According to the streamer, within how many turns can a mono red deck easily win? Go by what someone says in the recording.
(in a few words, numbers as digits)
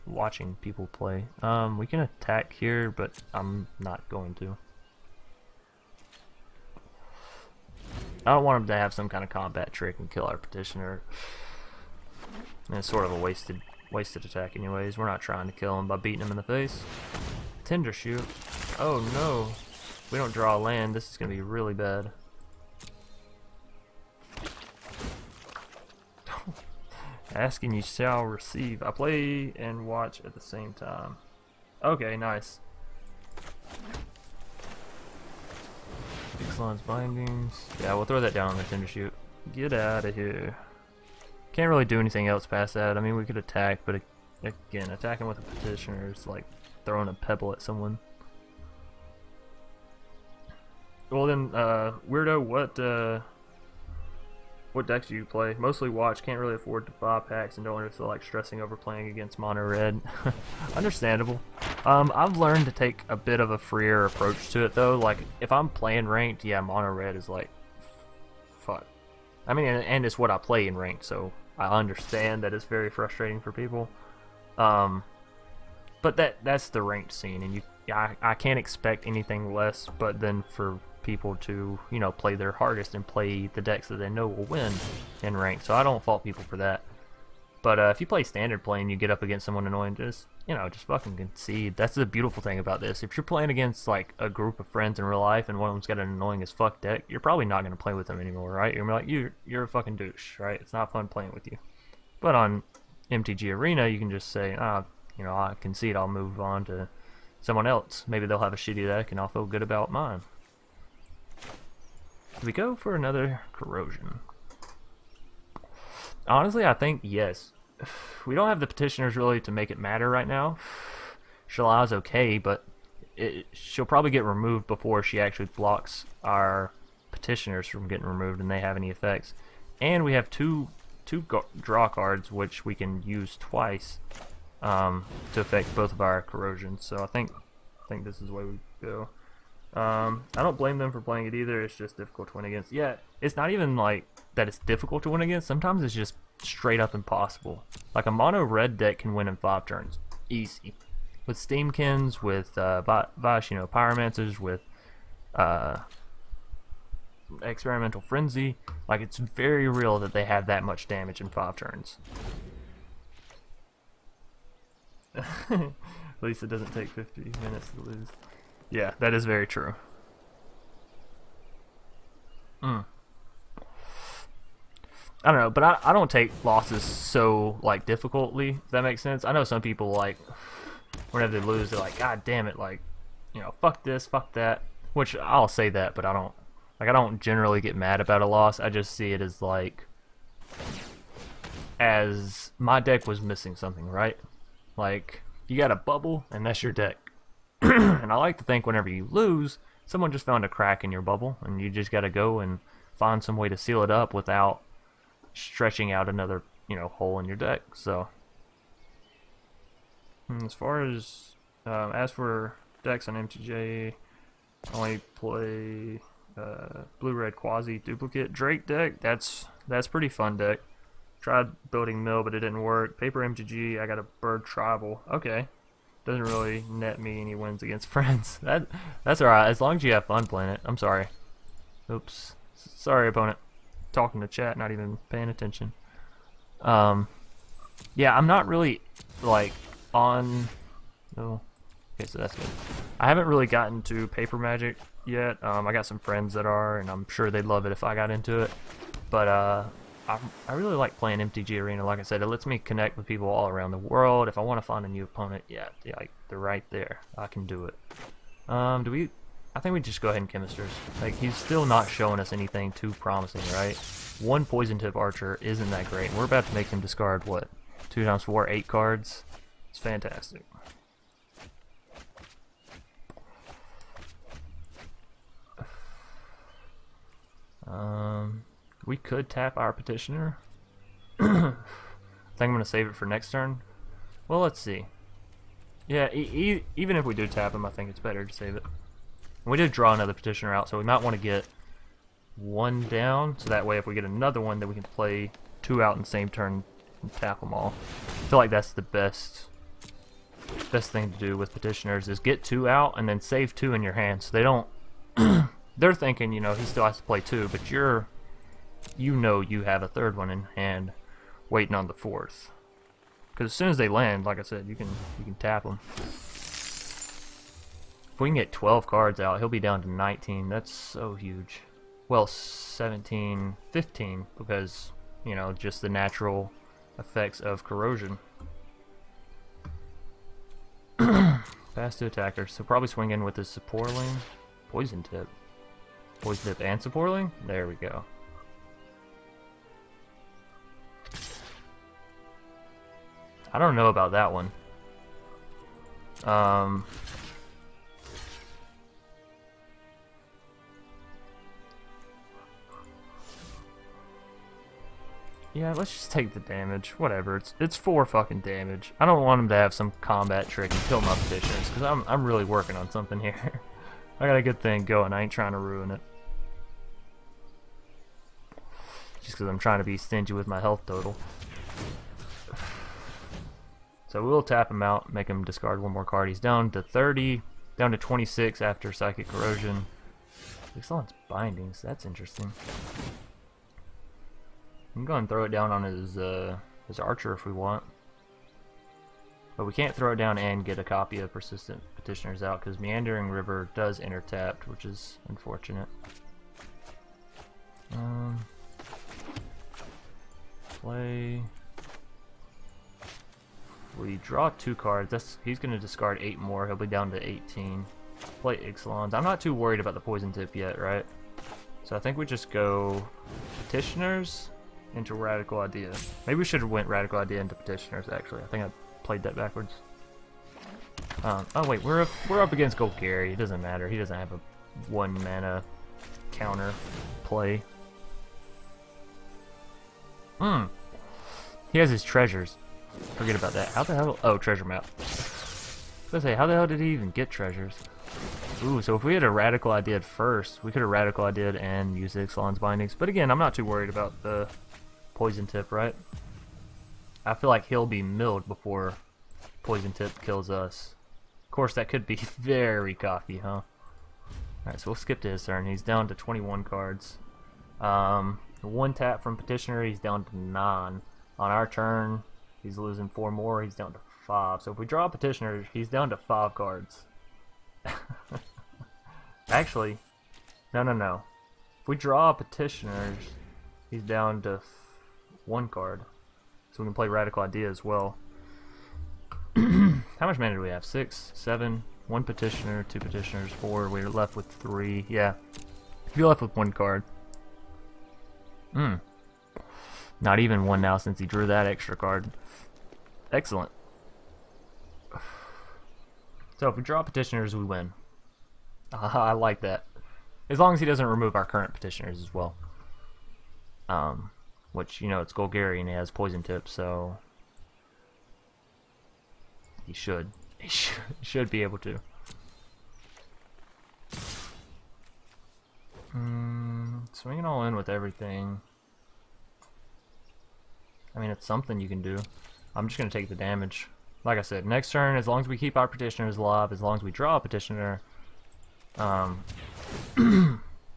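5.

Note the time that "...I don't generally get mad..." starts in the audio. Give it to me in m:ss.
3:06.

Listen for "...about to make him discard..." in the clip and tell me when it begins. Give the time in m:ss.
4:26.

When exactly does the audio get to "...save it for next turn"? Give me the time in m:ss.
4:42.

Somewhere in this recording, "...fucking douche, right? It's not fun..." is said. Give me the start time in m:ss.
1:39.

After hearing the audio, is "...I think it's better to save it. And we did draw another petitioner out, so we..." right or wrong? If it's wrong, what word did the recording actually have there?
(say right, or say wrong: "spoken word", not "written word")
right.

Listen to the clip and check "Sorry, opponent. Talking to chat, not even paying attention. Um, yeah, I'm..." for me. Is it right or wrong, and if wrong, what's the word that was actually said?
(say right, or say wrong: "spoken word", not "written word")
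right.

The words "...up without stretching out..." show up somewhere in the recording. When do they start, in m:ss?
3:23.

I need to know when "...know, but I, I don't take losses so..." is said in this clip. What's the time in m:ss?
2:55.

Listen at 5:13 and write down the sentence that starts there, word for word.
Because as soon as they land, like I said, you can you can tap them.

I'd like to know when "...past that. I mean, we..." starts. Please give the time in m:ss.
0:42.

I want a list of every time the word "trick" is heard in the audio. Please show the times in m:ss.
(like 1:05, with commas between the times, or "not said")
0:09, 6:00.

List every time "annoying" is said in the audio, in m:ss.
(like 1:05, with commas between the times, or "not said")
1:29, 1:36.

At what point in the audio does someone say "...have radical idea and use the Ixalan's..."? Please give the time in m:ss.
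7:20.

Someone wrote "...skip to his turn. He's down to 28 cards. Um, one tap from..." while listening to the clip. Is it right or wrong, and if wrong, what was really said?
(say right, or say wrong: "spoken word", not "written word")
wrong: "21", not "28".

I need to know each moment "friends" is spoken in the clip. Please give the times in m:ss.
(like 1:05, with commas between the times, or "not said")
1:34, 3:47, 4:05.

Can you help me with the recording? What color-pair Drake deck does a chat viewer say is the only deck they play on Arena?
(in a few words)
blue red.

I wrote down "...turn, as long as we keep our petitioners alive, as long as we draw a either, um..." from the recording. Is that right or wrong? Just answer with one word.
wrong.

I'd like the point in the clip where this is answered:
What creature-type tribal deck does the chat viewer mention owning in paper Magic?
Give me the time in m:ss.
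3:44.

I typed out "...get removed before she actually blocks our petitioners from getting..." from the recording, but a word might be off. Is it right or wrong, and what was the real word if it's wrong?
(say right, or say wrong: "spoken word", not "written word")
right.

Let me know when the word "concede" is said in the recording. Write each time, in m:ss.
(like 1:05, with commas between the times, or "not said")
1:31, 1:45.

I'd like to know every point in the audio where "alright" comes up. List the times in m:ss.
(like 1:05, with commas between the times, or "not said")
3:49, 7:34.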